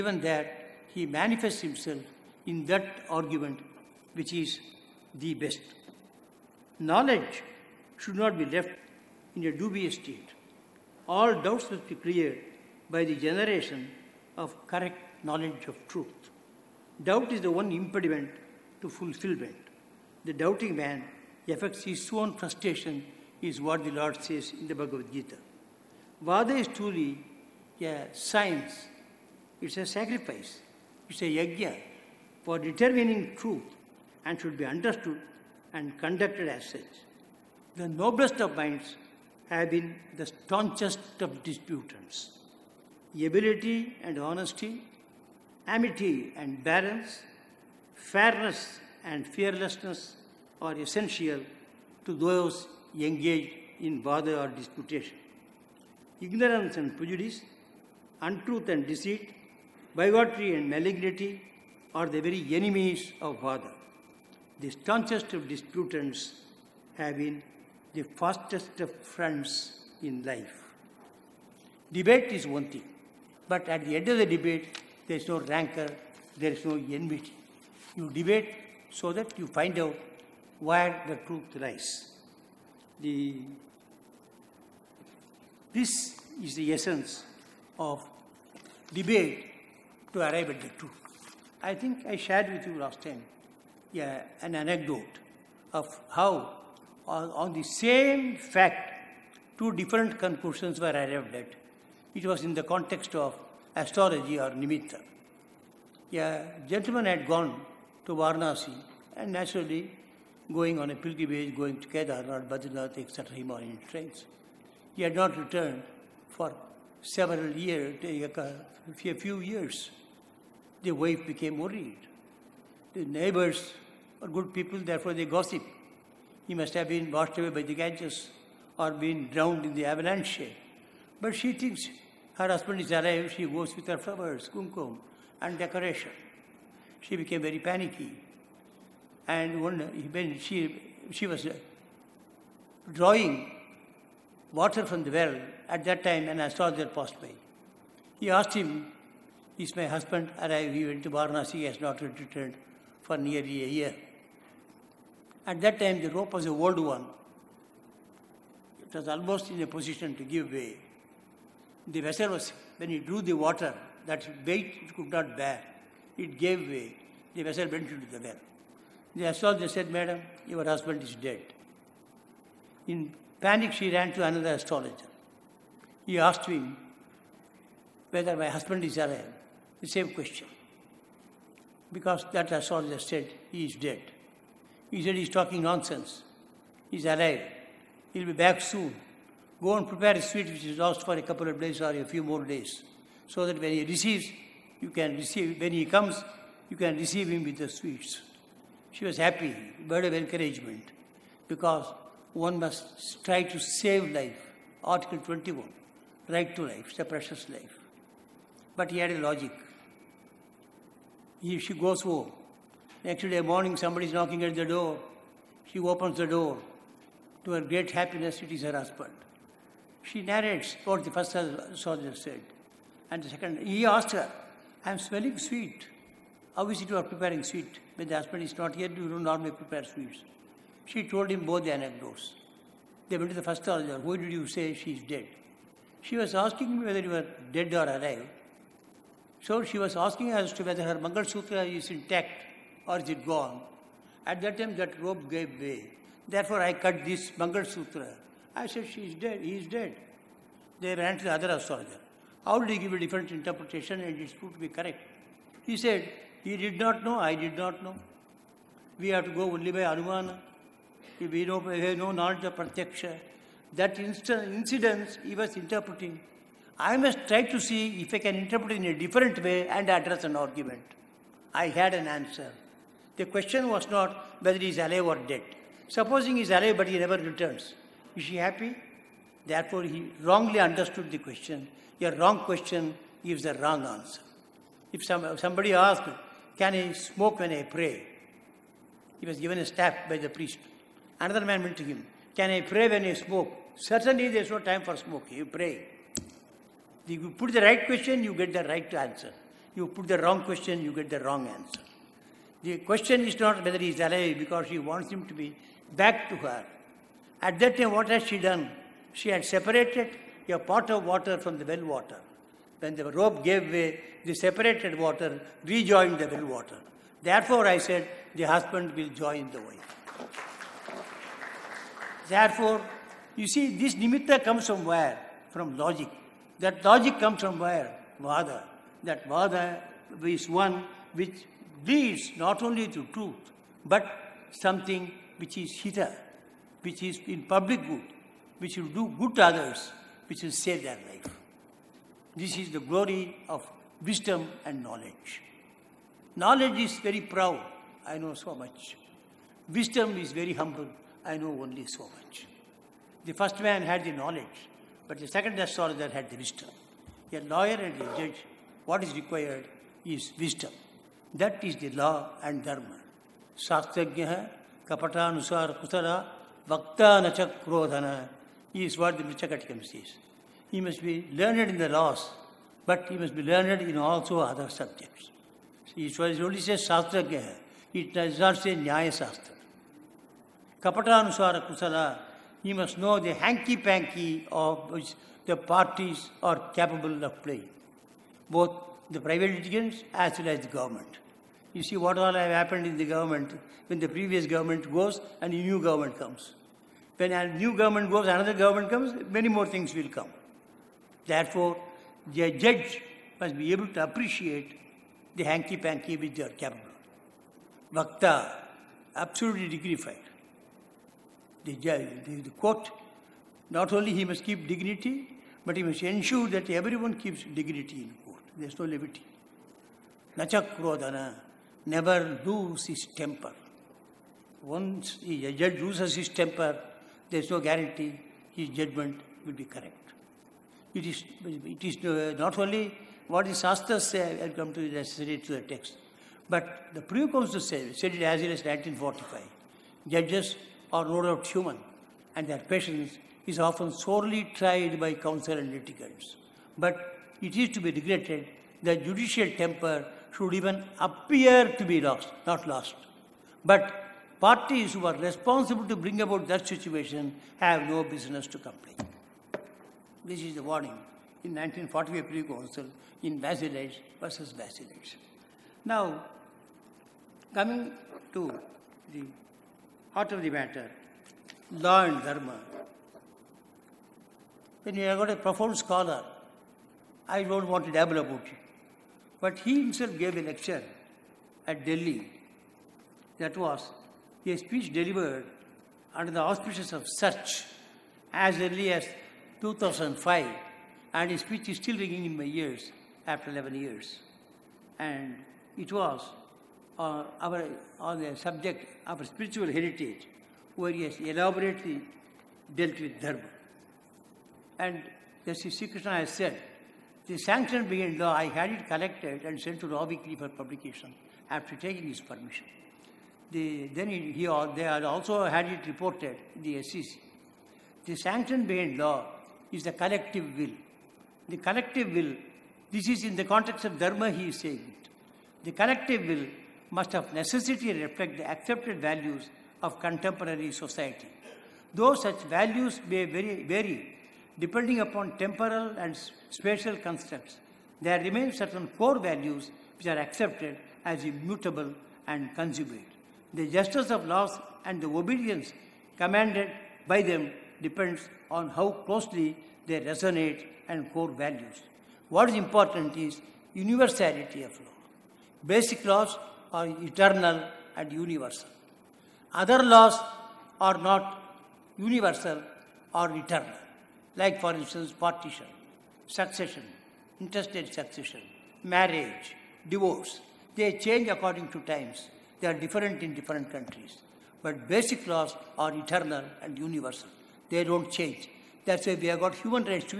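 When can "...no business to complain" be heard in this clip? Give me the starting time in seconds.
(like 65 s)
457 s.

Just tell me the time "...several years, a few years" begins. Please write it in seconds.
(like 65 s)
117 s.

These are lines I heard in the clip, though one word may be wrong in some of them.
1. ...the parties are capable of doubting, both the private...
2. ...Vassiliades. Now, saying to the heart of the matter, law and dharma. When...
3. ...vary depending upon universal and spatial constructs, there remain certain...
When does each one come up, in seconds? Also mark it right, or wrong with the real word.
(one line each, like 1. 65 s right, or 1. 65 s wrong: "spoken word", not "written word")
1. 385 s wrong: "playing", not "doubting"
2. 464 s wrong: "coming", not "saying"
3. 533 s wrong: "temporal", not "universal".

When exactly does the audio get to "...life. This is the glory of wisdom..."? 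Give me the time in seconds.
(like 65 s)
341 s.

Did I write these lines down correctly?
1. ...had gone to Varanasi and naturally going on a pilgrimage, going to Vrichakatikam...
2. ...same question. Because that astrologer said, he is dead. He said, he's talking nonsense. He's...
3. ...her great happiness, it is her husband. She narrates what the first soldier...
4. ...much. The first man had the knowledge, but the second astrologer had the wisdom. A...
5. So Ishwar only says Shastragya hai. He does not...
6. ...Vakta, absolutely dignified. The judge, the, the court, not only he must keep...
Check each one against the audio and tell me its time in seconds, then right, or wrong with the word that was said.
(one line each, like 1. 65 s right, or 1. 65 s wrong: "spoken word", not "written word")
1. 107 s wrong: "Kedarnath", not "Vrichakatikam"
2. 179 s right
3. 217 s right
4. 352 s right
5. 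375 s right
6. 407 s right.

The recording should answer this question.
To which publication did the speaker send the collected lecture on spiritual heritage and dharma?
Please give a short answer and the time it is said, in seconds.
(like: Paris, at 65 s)
Law Weekly, at 509 s.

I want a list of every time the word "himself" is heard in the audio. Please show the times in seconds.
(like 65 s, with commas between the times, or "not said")
1 s, 479 s.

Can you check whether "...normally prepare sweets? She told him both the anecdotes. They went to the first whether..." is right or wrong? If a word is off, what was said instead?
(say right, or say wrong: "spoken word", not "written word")
wrong: "soldier", not "whether".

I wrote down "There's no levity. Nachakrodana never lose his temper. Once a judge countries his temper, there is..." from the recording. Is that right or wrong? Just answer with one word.
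wrong.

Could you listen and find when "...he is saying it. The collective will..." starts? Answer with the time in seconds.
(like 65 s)
524 s.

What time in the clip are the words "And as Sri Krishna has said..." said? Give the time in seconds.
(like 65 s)
504 s.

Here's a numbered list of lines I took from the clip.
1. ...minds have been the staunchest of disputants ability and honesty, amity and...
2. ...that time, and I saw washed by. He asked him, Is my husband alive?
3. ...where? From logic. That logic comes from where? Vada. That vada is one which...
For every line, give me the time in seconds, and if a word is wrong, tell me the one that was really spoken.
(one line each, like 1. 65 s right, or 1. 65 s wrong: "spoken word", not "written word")
1. 38 s right
2. 145 s wrong: "passed", not "washed"
3. 324 s right.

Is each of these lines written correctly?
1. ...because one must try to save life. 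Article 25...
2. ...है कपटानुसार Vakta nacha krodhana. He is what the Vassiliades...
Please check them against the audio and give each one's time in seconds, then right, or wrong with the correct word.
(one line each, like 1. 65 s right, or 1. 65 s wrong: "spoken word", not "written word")
1. 201 s wrong: "21", not "25"
2. 364 s wrong: "Vrichakatikam", not "Vassiliades".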